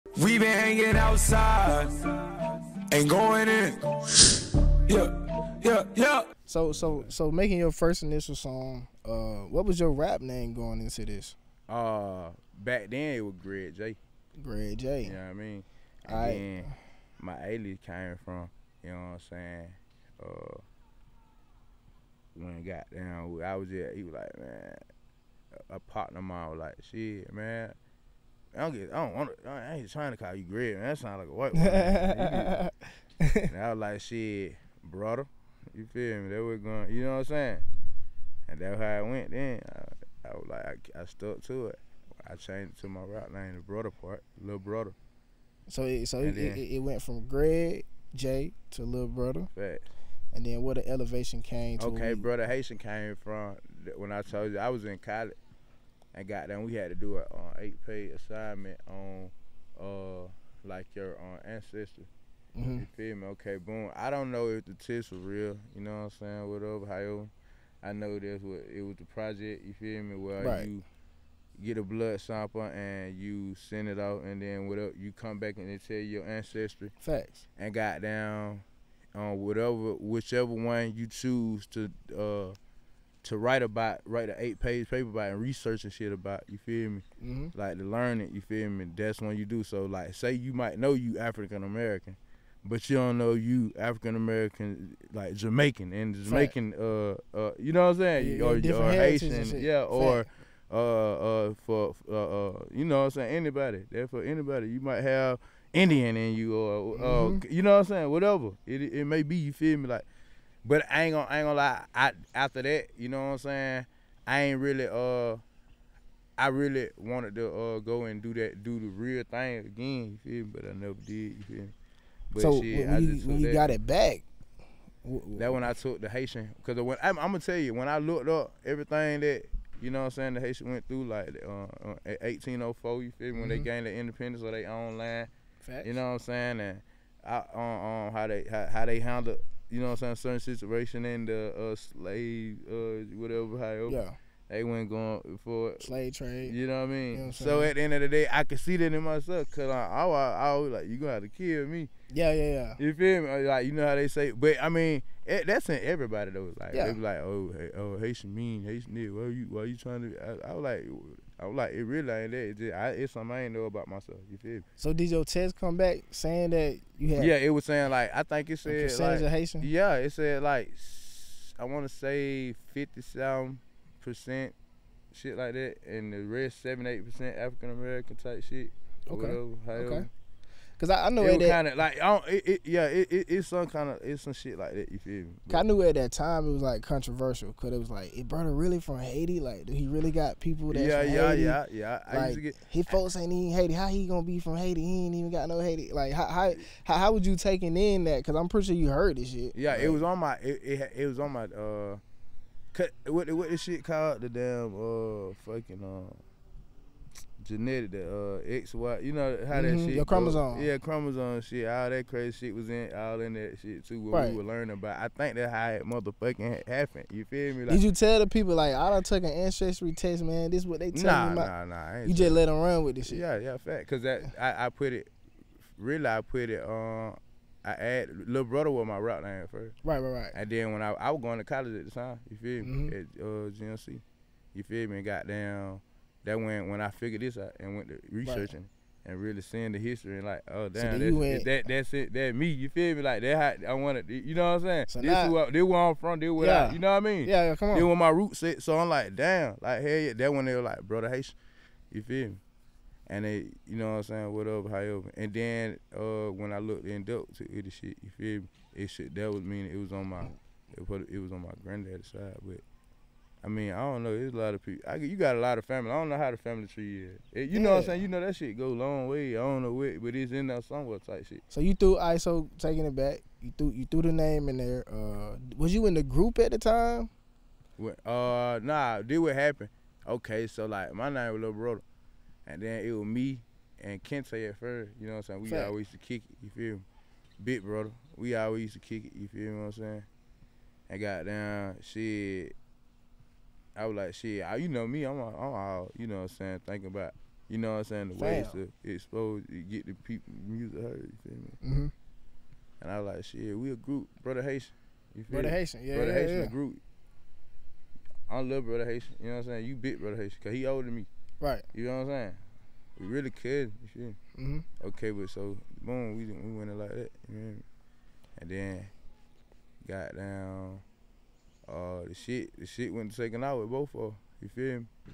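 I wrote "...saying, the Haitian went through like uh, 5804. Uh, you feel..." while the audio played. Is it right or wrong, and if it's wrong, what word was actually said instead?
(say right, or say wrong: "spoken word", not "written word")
wrong: "1804", not "5804".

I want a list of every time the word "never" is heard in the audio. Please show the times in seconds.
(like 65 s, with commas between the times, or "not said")
120 s.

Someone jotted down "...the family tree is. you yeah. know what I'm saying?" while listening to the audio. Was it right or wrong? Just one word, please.
right.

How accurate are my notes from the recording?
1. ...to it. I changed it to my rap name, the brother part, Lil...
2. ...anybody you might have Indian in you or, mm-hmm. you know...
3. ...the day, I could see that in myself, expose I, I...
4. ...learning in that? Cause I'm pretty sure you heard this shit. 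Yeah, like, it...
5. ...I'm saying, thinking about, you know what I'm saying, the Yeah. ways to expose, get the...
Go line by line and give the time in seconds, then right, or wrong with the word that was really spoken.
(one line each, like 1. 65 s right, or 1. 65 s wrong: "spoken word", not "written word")
1. 41 s right
2. 104 s right
3. 148 s wrong: "cause", not "expose"
4. 197 s wrong: "taking", not "learning"
5. 296 s wrong: "Damn", not "Yeah".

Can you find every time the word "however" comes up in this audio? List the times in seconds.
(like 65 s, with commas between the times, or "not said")
66 s, 254 s.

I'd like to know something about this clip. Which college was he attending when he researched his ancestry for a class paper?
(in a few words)
GMC.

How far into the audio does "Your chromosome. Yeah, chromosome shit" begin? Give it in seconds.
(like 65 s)
209 s.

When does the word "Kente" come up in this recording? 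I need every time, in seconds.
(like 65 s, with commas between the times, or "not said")
284 s.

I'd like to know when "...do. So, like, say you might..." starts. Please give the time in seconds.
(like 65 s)
89 s.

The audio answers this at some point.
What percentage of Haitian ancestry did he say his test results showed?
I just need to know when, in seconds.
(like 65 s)
172 s.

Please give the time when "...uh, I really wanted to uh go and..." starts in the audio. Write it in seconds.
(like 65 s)
114 s.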